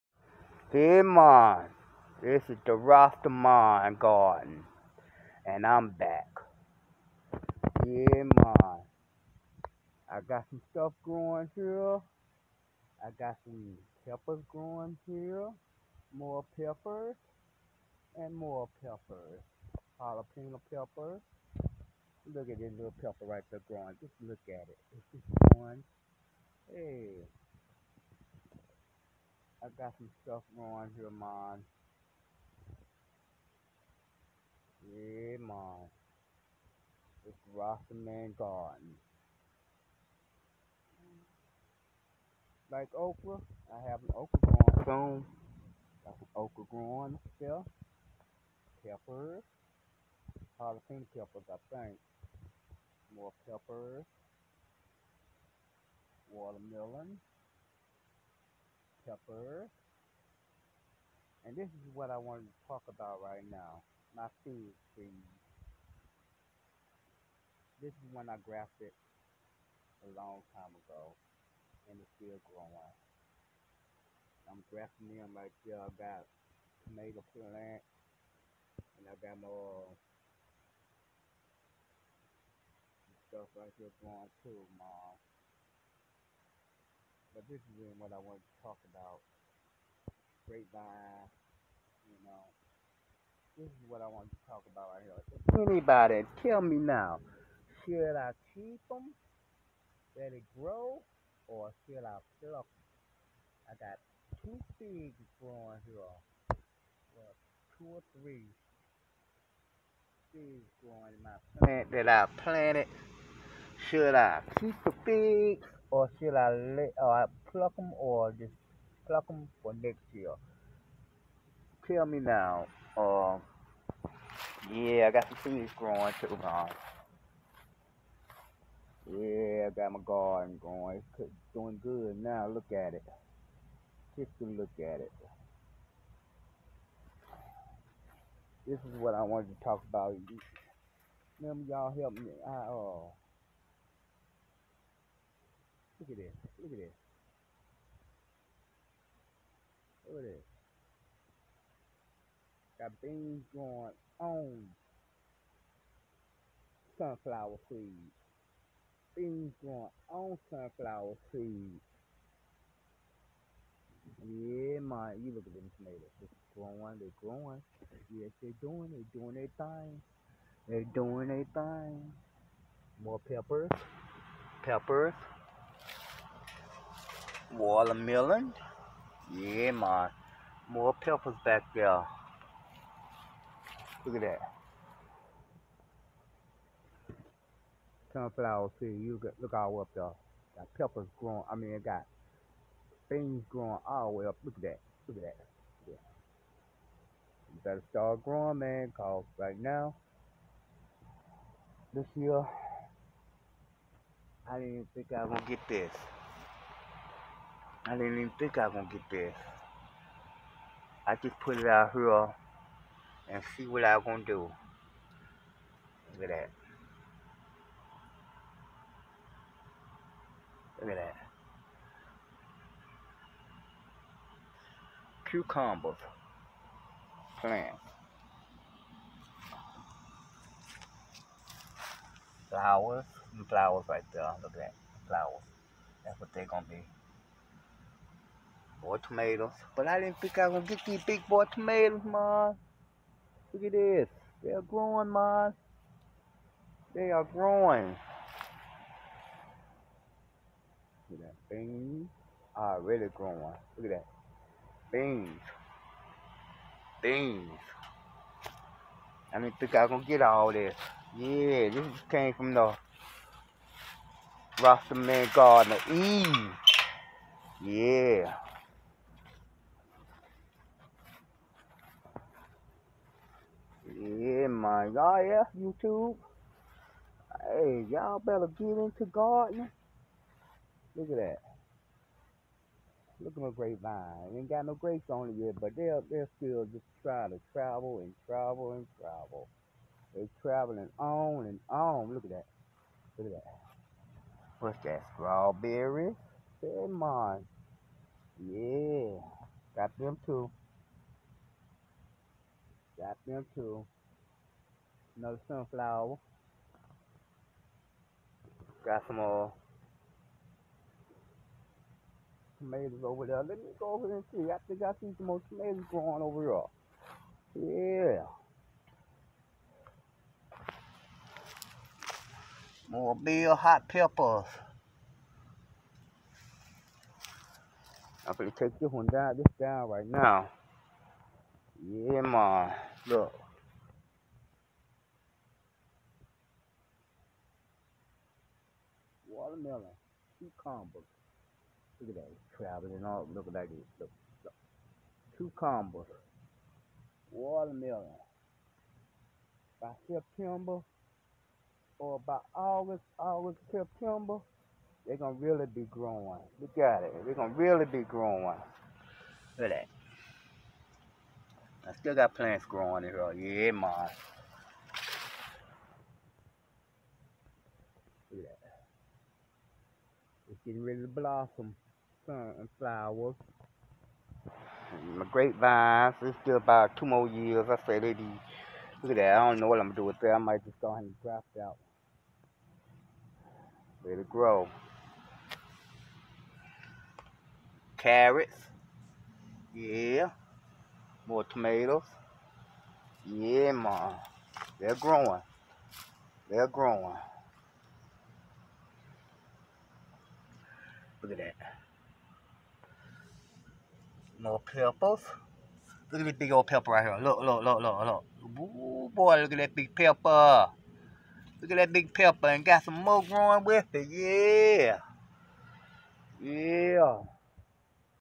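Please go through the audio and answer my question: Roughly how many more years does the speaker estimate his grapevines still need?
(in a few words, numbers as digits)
2.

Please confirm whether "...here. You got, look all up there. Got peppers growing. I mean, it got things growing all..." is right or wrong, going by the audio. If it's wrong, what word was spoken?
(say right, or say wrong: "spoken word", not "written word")
right.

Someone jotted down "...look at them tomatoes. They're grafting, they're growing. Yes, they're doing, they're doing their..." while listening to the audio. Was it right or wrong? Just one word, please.
wrong.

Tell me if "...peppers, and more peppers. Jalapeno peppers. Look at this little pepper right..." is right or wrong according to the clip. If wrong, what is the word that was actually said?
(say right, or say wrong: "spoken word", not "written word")
right.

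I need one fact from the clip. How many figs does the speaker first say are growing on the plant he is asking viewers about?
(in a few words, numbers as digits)
2.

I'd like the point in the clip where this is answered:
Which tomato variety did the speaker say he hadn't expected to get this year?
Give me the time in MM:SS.
04:01.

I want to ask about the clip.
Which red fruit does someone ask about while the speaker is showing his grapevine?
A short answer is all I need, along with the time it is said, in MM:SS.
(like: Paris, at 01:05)
Strawberry, at 04:55.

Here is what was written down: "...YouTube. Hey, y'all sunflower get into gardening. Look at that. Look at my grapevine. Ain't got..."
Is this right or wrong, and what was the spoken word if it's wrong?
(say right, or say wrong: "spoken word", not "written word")
wrong: "better", not "sunflower".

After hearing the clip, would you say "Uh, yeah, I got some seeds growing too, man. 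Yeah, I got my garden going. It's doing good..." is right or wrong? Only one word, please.
right.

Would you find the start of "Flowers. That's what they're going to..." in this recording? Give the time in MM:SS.
03:55.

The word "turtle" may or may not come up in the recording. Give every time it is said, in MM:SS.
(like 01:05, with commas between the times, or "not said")
not said.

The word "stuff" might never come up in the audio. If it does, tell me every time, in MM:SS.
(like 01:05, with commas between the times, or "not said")
00:10, 00:30, 01:23.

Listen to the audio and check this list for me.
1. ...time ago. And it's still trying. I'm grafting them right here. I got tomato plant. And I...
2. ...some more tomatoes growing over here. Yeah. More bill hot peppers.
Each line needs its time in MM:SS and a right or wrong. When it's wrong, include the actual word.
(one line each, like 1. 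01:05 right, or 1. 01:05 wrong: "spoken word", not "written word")
1. 01:10 wrong: "growing", not "trying"
2. 05:15 right.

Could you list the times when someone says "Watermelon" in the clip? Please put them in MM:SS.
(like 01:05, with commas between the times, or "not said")
00:56, 02:57, 05:47.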